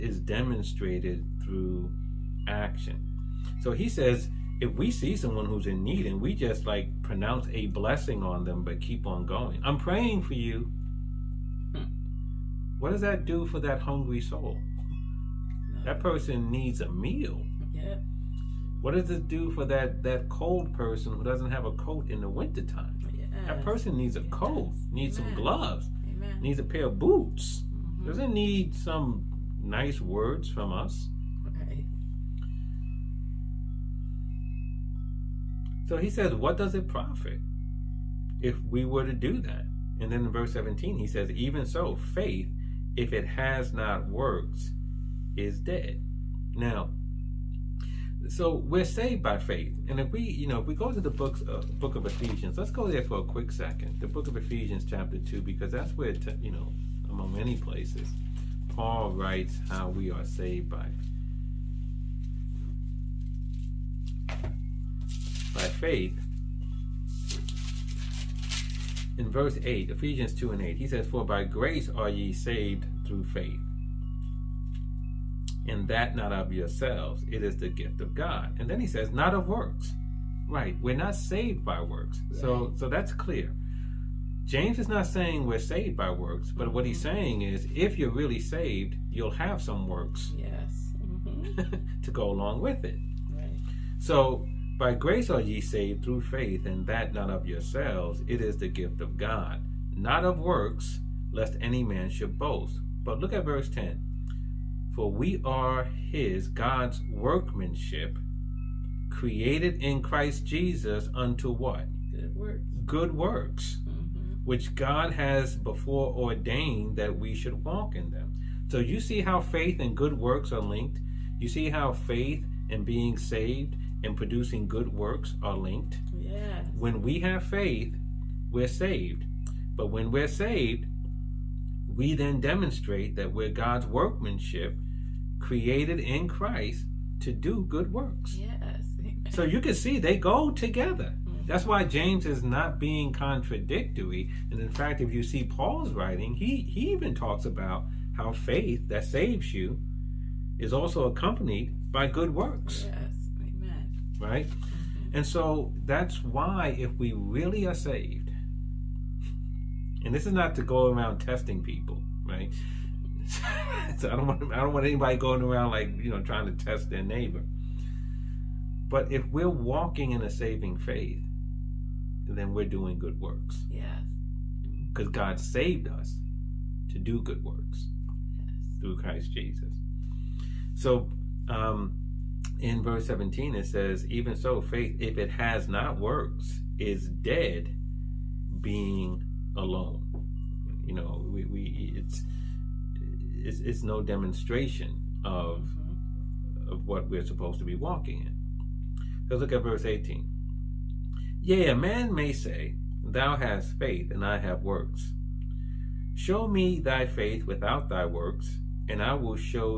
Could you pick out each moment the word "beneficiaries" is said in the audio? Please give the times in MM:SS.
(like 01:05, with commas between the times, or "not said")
not said.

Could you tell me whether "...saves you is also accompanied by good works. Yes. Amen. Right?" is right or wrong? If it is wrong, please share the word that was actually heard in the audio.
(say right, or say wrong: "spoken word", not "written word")
right.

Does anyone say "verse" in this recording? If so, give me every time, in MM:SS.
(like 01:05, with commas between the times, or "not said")
00:40, 01:09, 01:43, 03:02, 03:19.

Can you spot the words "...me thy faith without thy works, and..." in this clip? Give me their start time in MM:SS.
03:26.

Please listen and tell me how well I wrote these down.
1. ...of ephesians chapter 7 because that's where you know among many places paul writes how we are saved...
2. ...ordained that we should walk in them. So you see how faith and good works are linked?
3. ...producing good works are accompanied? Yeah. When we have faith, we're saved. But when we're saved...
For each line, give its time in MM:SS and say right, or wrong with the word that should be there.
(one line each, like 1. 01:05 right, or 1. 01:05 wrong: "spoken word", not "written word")
1. 00:54 wrong: "2", not "7"
2. 01:56 right
3. 02:04 wrong: "linked", not "accompanied".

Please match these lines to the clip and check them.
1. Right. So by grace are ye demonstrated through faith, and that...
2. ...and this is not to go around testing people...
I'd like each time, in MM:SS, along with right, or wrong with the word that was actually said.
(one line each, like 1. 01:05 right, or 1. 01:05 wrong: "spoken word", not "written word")
1. 01:33 wrong: "saved", not "demonstrated"
2. 02:40 right.